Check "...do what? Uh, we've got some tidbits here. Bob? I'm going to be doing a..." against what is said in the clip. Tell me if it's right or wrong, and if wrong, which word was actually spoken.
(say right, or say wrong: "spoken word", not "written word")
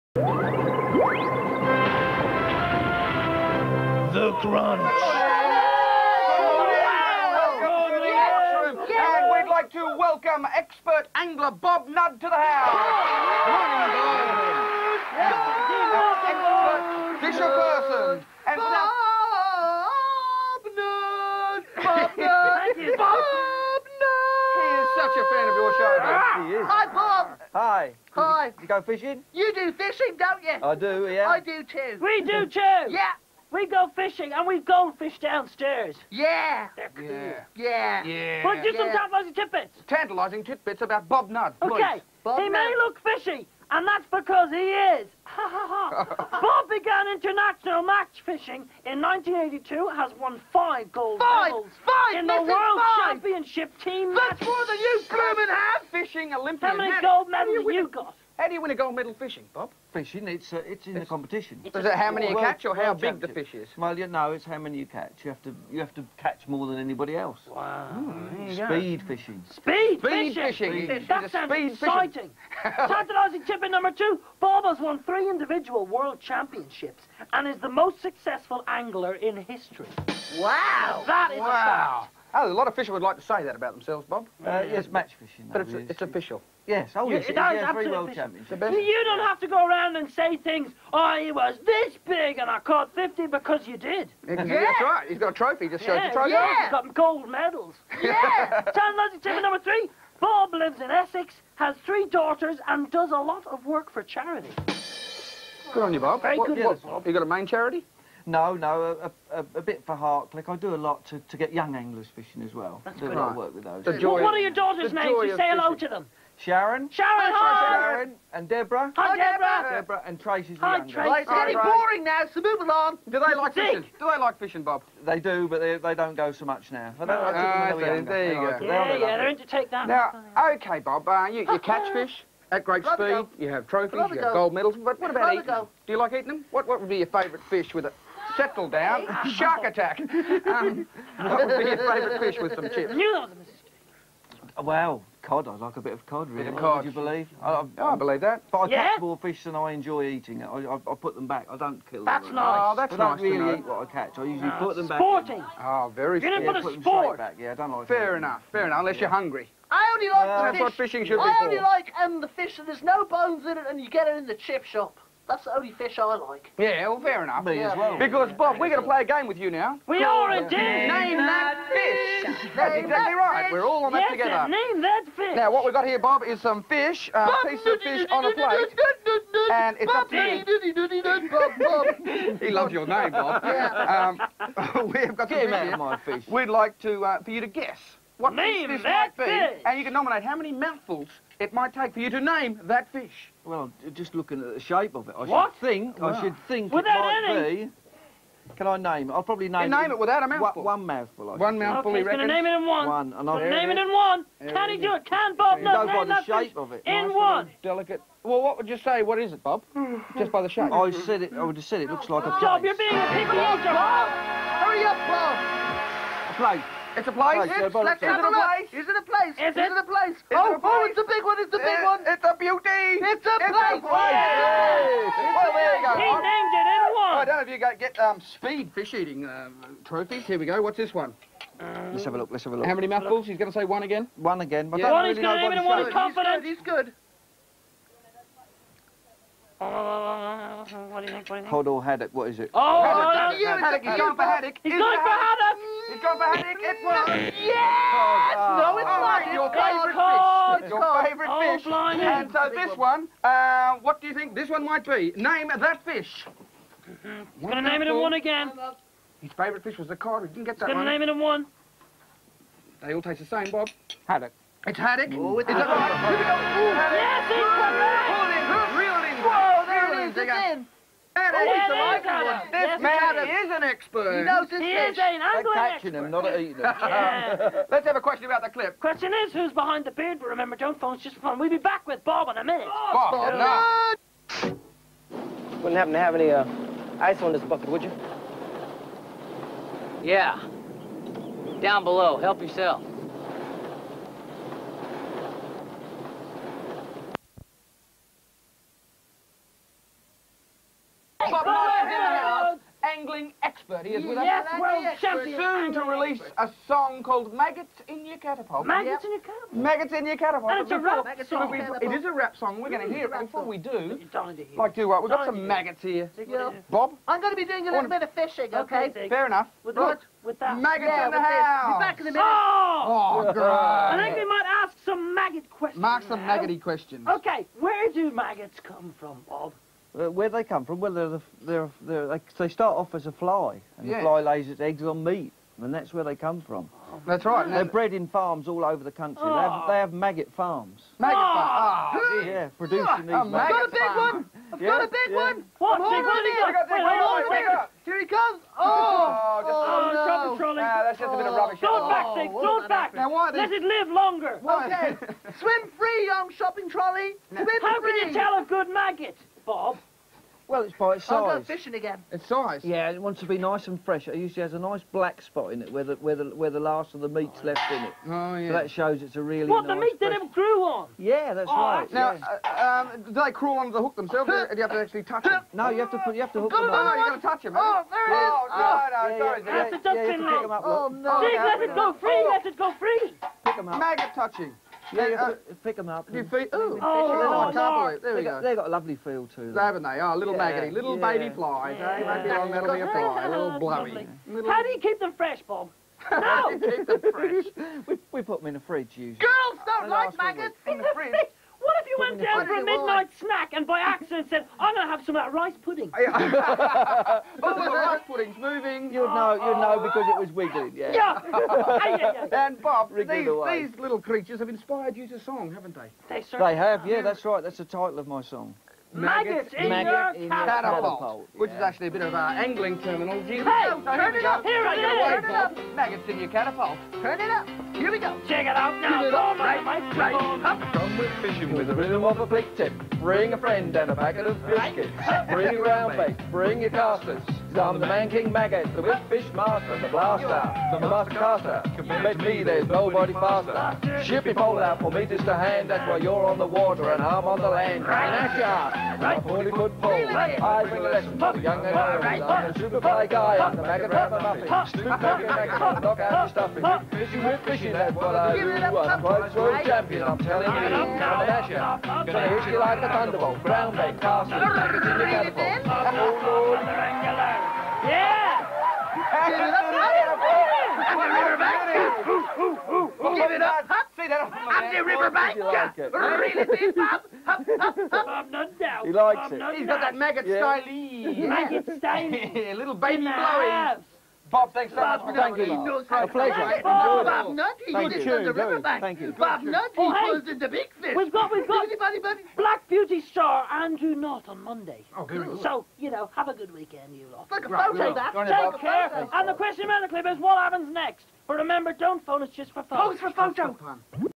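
wrong: "maggots", not "tidbits".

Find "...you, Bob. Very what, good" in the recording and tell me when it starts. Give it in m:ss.
1:45.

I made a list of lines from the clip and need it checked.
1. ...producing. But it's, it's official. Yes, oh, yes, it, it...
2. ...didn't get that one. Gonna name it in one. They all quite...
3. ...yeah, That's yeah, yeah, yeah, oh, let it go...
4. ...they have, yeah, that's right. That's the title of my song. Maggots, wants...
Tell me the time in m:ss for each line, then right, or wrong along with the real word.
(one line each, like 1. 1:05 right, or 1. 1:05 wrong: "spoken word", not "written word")
1. 1:25 wrong: "fishing", not "producing"
2. 4:20 wrong: "taste", not "quite"
3. 6:19 right
4. 6:56 wrong: "maggots", not "wants".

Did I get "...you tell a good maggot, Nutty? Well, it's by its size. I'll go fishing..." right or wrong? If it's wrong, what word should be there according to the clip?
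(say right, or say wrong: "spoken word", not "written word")
wrong: "Bob", not "Nutty".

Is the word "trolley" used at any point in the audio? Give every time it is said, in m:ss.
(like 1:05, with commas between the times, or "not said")
5:56.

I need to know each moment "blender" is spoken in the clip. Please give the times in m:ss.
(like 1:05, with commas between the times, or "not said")
not said.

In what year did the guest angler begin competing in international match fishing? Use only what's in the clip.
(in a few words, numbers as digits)
1982.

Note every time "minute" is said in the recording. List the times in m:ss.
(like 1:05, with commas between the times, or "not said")
4:42, 5:22.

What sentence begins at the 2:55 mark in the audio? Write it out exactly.
Now, what we've got here, Bob, is some fish, a uh, piece of fish on a plate.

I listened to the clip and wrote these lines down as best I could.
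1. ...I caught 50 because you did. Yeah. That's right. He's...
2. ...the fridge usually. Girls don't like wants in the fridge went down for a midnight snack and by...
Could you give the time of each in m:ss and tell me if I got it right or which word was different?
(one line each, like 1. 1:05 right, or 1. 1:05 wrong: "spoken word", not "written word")
1. 1:32 right
2. 6:38 wrong: "maggots", not "wants".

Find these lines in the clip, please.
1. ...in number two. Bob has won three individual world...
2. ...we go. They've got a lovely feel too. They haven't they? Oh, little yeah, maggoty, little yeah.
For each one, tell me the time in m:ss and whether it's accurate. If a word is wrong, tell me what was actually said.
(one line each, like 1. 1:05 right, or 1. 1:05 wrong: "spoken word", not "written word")
1. 1:13 right
2. 6:28 right.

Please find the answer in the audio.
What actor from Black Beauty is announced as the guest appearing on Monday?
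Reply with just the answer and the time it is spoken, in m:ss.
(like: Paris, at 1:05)
Andrew Knott, at 8:13.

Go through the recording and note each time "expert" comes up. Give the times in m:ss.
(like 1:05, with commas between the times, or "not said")
0:10, 4:33, 5:03.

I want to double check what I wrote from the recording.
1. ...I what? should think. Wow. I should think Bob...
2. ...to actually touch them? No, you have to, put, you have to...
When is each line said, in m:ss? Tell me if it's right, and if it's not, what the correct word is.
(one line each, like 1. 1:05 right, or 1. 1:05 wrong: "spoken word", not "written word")
1. 3:15 wrong: "Without", not "Bob"
2. 6:14 right.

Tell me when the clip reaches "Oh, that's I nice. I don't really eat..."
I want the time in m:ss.
2:32.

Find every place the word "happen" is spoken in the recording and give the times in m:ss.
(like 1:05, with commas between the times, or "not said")
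4:45, 8:20.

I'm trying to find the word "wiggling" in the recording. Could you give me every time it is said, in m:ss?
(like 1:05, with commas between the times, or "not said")
6:50.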